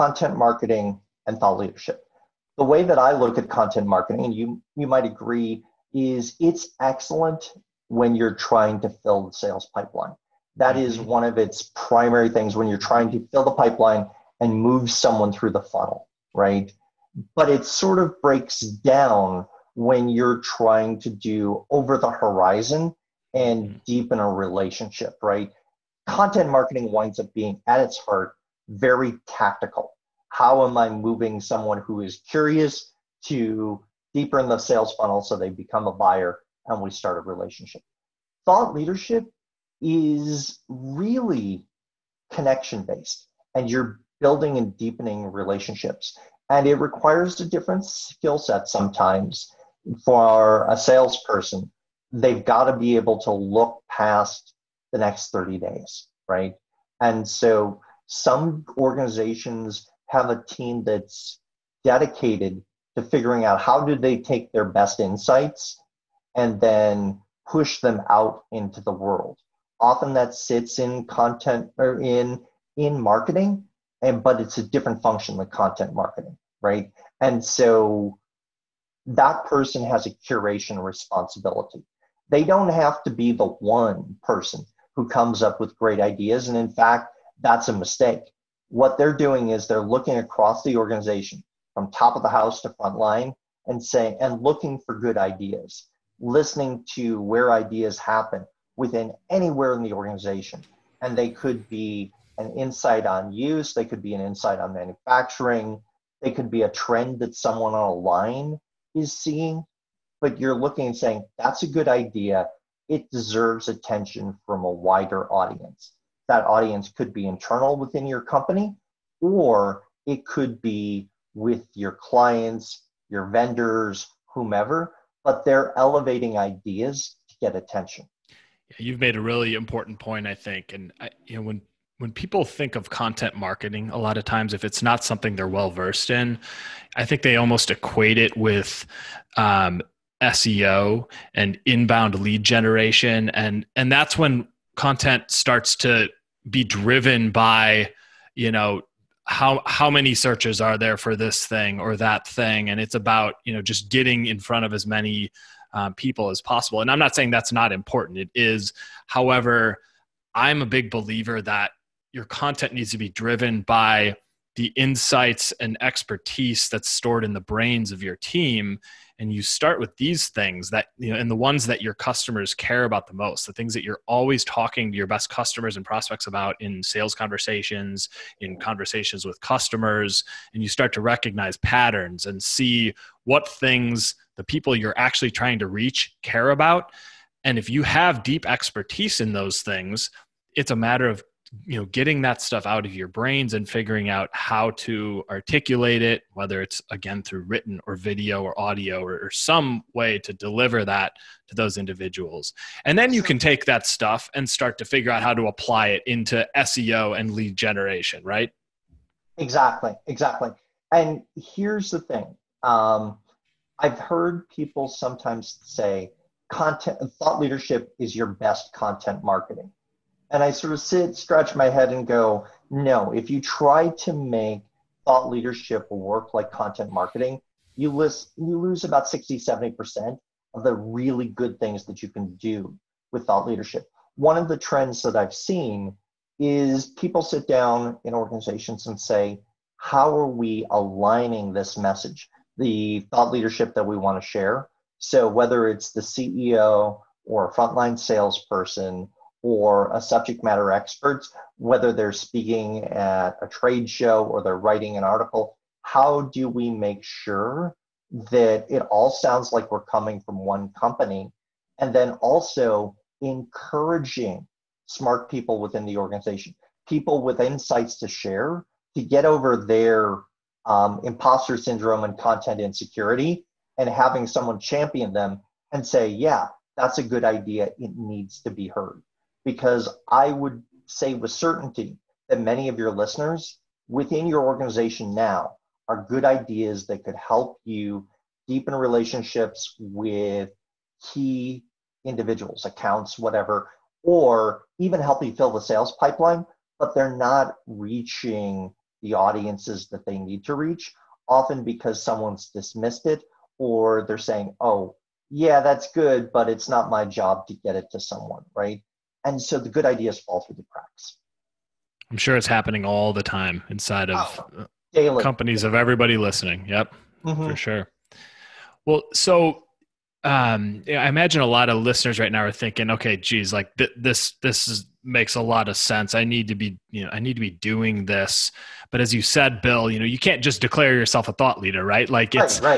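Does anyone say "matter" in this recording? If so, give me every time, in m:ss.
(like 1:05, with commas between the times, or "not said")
3:10, 4:10.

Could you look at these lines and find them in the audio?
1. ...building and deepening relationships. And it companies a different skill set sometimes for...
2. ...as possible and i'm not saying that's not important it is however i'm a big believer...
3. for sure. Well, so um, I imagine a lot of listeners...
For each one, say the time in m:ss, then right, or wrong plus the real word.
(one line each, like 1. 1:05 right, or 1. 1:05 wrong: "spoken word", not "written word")
1. 0:44 wrong: "requires", not "companies"
2. 2:36 right
3. 5:17 right.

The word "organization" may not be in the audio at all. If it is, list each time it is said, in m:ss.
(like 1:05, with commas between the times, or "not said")
0:58, 1:30, 1:39, 3:58, 4:25, 4:44.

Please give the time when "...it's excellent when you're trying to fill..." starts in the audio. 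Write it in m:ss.
0:06.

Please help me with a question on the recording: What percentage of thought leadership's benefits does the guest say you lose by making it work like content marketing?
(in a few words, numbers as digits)
60-70%.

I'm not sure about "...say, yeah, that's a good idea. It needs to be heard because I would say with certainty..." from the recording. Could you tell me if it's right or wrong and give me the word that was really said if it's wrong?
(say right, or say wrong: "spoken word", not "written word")
right.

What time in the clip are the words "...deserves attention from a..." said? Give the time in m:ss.
1:53.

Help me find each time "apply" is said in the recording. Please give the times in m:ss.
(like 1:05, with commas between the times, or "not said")
3:25.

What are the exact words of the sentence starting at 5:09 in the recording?
and so the good ideas fall through the cracks.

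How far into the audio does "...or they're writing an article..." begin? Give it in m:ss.
4:14.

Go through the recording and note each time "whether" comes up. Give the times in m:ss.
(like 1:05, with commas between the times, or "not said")
3:16, 4:05, 4:11.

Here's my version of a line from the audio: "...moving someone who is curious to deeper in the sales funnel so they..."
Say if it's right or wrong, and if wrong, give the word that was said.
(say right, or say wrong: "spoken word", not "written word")
right.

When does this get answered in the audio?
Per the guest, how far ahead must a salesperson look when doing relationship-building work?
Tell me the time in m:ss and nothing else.
0:54.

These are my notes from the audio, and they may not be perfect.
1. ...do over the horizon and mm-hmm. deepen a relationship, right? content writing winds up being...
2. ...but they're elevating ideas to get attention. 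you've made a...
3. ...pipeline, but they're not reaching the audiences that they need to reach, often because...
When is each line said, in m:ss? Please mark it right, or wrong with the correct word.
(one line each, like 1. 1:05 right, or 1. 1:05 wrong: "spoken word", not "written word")
1. 0:21 wrong: "marketing", not "writing"
2. 2:05 right
3. 4:55 right.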